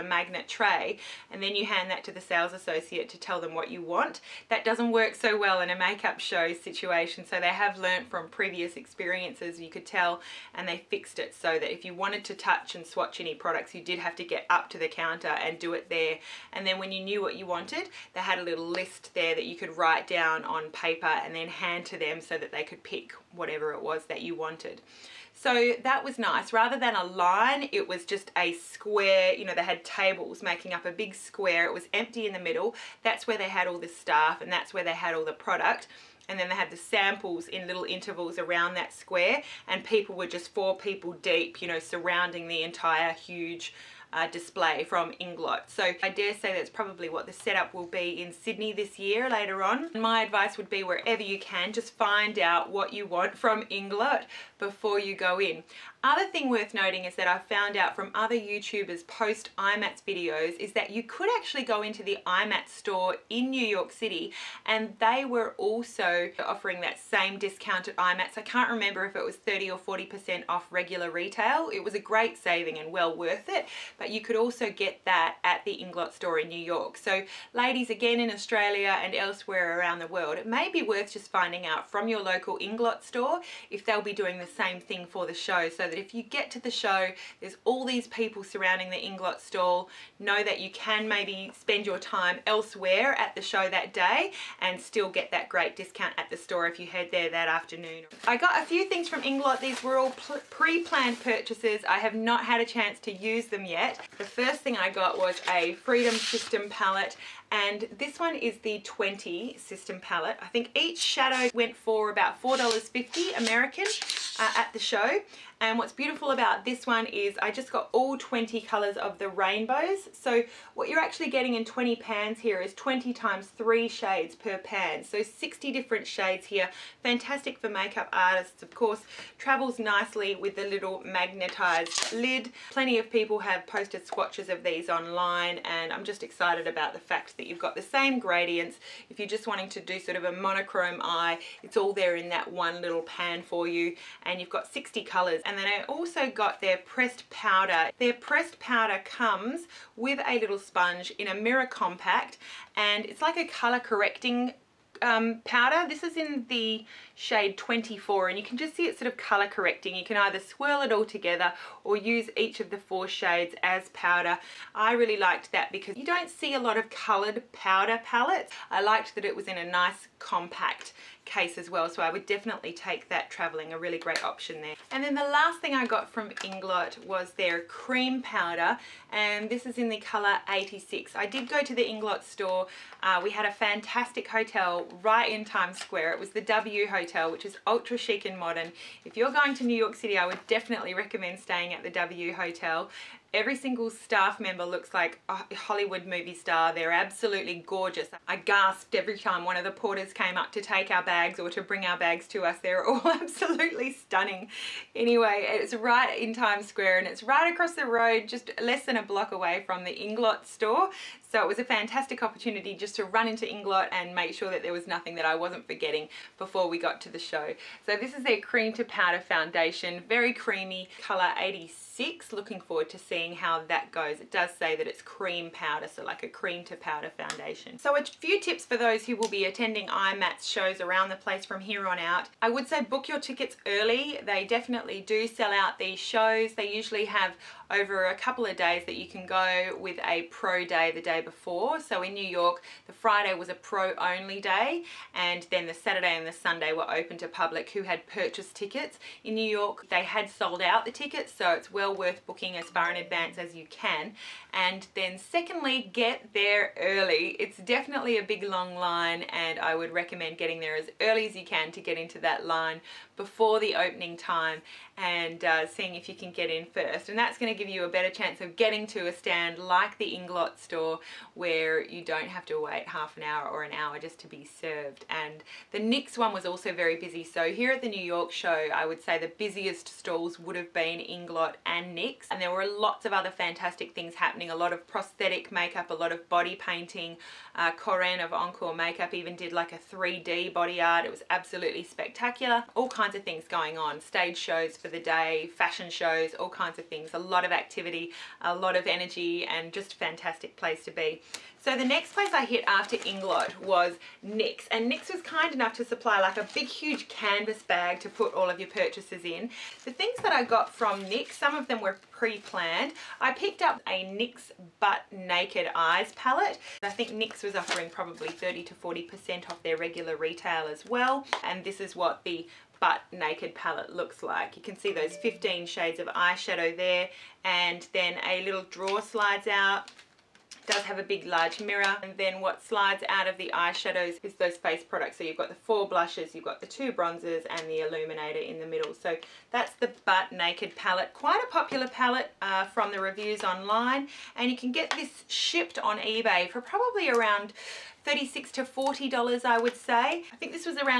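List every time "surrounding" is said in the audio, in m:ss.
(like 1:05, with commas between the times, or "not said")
0:41, 1:28.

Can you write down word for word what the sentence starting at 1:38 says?
I got a few things from Inglot.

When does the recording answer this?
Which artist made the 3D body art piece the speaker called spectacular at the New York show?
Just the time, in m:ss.
4:47.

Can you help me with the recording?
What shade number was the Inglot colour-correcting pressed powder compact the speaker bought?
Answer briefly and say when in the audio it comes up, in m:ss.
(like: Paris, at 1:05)
24, at 2:37.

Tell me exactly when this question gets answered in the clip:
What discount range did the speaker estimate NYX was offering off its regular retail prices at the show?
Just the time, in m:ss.
5:18.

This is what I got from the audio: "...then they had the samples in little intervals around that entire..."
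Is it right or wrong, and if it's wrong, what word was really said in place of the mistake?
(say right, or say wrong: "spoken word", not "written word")
wrong: "square", not "entire".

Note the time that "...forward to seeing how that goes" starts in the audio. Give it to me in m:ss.
3:42.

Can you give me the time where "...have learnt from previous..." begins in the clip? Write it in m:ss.
0:07.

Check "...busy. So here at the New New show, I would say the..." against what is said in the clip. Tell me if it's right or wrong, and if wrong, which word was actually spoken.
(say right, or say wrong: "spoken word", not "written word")
wrong: "York", not "New".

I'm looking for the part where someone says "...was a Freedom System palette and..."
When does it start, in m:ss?
1:45.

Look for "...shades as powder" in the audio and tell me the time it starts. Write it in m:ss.
2:43.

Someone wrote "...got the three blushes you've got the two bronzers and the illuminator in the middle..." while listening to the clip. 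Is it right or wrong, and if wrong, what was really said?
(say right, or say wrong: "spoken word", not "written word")
wrong: "four", not "three".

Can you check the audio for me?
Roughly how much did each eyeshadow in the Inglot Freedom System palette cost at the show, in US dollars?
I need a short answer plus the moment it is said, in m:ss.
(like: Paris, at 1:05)
$4.50, at 1:52.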